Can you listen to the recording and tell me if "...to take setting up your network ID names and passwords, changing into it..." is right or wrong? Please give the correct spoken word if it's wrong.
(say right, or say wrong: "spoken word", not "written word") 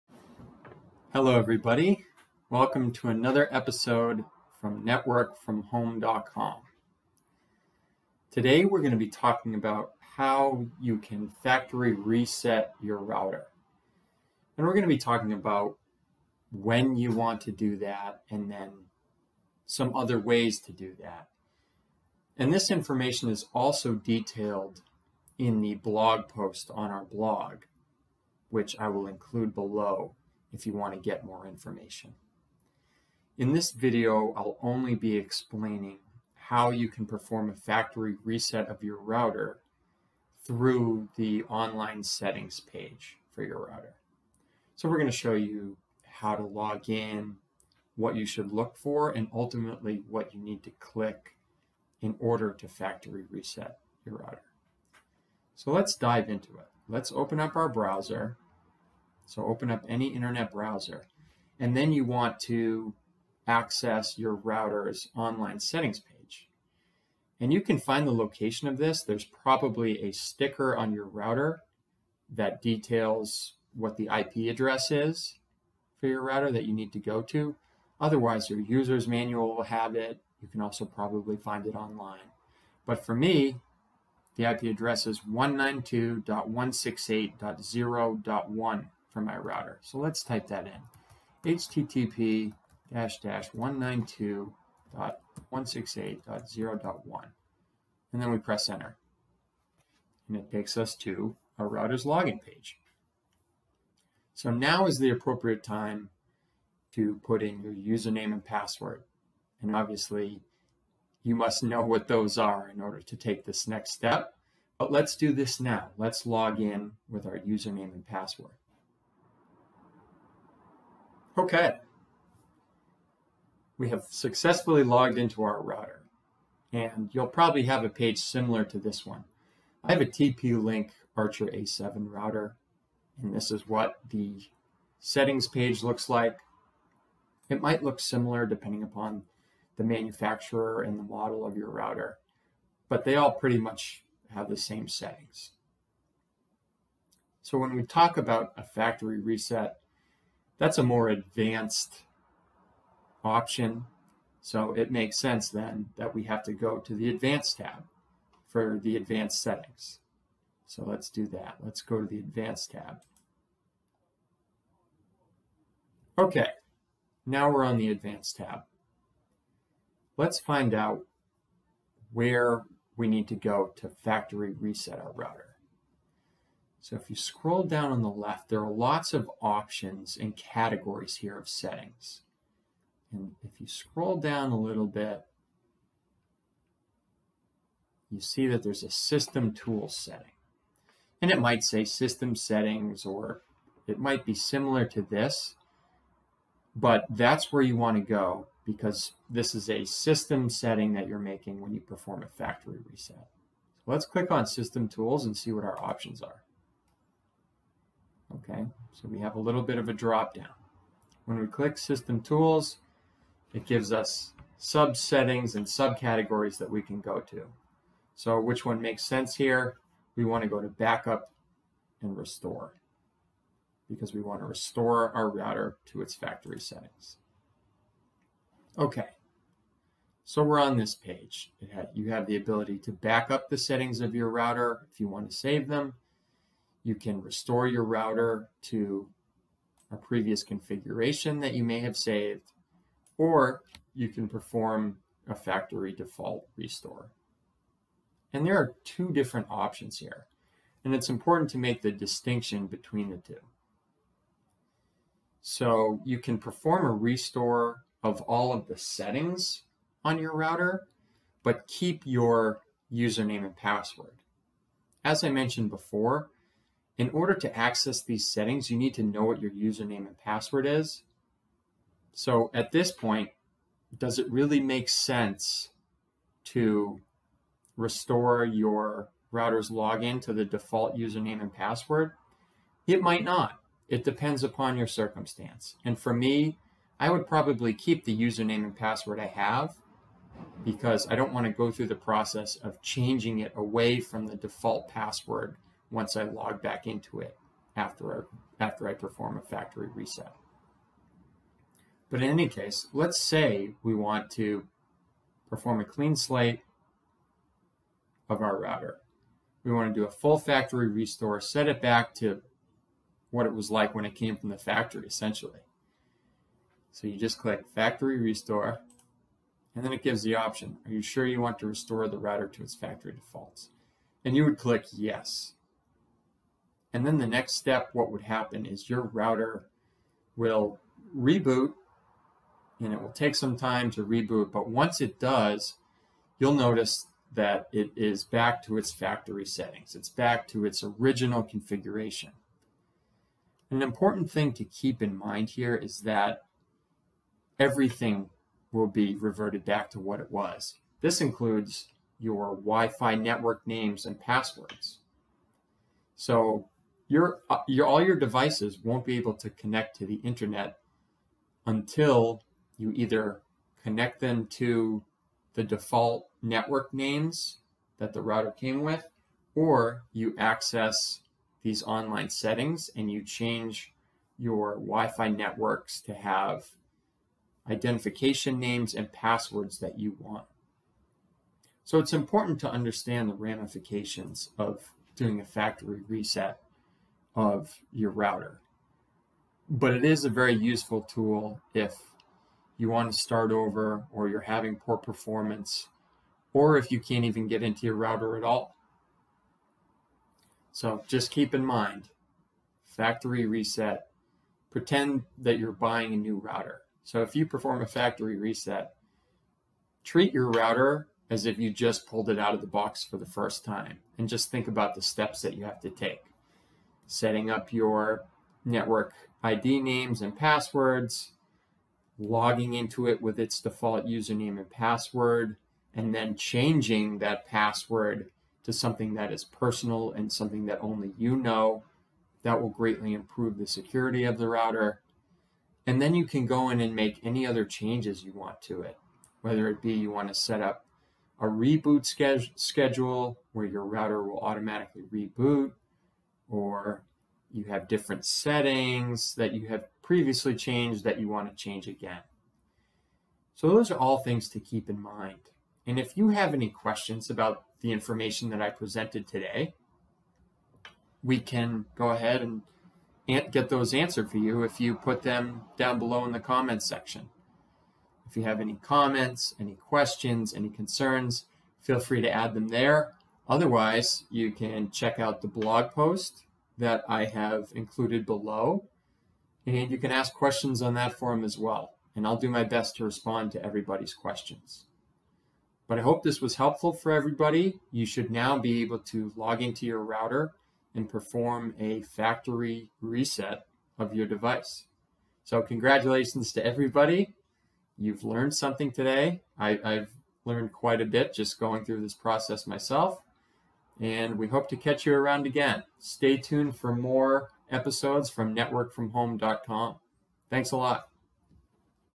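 wrong: "logging", not "changing".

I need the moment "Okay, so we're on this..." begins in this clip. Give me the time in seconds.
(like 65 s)
228 s.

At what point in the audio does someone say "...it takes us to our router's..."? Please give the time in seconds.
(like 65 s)
100 s.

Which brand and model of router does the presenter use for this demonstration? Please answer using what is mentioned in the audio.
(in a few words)
TP-Link Archer A7.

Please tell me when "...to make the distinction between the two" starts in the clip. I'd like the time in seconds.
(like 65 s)
251 s.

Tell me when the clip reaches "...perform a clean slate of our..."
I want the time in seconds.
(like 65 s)
305 s.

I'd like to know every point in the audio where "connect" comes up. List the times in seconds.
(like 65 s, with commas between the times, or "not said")
359 s, 363 s.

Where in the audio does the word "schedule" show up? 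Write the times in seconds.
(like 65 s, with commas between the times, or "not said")
442 s.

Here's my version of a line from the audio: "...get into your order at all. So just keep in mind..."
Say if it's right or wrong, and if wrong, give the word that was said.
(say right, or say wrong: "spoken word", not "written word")
wrong: "router", not "order".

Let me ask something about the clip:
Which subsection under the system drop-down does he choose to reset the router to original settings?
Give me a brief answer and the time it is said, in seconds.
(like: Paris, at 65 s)
Backup and Restore, at 220 s.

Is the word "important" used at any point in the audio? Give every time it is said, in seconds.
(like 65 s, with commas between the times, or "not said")
251 s, 343 s, 382 s.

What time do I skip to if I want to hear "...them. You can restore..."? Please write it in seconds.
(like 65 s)
235 s.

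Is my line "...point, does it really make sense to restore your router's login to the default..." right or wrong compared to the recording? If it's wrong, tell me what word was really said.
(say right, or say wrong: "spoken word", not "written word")
right.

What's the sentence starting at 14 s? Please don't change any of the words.
And we're going to be talking about when you want to do that and then some other ways to do that.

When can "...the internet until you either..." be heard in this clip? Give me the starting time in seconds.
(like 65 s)
360 s.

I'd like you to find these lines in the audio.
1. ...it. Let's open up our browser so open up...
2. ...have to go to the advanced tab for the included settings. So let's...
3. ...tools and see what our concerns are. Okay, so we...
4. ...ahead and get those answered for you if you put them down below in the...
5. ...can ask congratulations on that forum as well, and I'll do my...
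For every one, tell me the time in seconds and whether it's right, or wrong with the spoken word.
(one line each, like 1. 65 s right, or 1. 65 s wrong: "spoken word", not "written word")
1. 56 s right
2. 156 s wrong: "advanced", not "included"
3. 204 s wrong: "options", not "concerns"
4. 462 s right
5. 479 s wrong: "questions", not "congratulations".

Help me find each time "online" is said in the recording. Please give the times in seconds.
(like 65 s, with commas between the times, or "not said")
41 s, 65 s, 81 s, 371 s.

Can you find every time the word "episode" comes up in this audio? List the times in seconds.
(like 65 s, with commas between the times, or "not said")
3 s, 507 s.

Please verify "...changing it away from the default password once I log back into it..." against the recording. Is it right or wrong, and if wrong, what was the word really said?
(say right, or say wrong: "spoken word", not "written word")
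right.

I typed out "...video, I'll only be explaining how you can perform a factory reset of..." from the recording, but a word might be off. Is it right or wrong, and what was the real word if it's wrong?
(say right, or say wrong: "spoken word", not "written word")
right.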